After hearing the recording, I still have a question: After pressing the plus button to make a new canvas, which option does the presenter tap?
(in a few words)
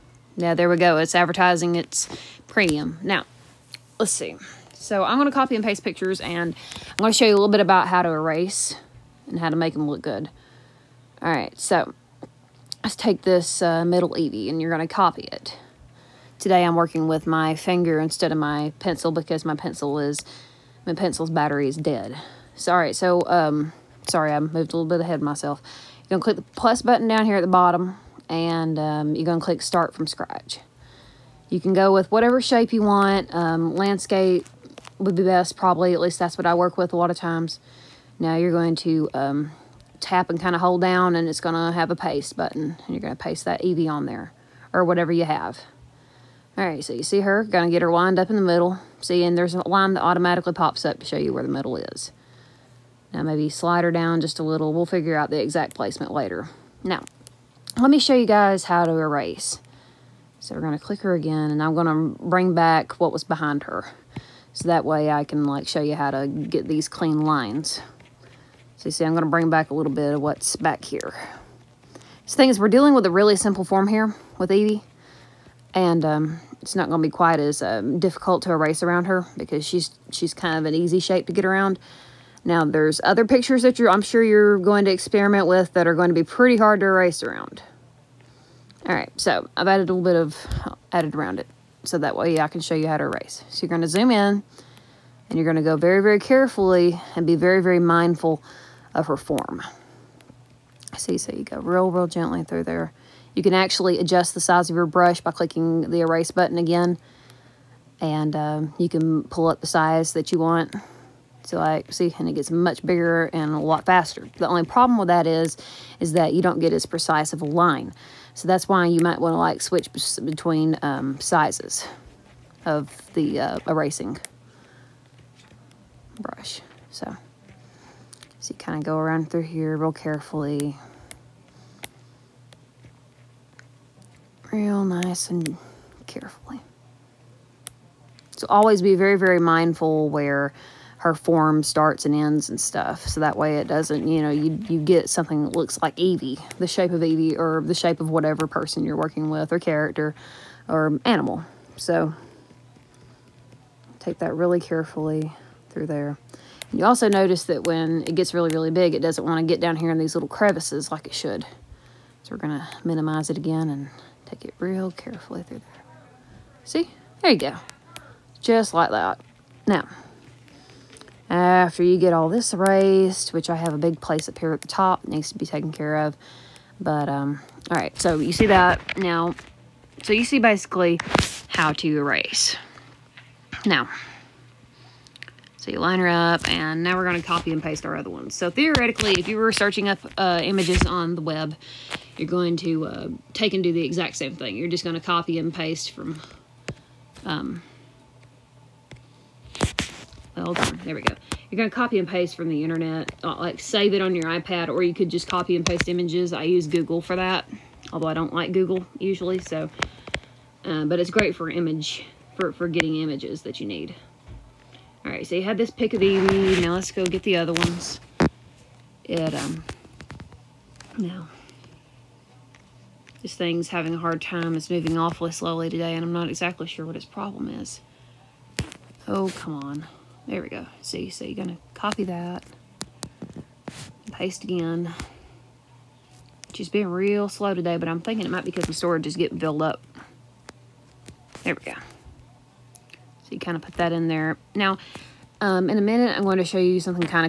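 Start from scratch.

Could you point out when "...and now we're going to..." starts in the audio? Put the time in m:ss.
3:06.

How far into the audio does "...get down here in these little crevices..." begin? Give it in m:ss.
2:39.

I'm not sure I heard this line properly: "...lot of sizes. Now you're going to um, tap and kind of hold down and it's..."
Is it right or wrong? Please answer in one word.
wrong.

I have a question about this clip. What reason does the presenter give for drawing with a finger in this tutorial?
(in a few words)
Pencil battery is dead.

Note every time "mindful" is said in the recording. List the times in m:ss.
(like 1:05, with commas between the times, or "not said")
1:37, 2:19.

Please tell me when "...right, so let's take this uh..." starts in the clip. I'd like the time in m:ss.
0:11.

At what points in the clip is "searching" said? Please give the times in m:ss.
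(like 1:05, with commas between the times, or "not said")
3:09.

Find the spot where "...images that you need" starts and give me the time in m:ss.
3:32.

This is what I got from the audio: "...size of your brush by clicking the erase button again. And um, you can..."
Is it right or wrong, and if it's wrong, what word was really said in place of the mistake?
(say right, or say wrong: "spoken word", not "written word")
right.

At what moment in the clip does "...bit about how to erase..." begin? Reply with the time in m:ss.
0:07.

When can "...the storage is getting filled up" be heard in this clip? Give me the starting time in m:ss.
3:58.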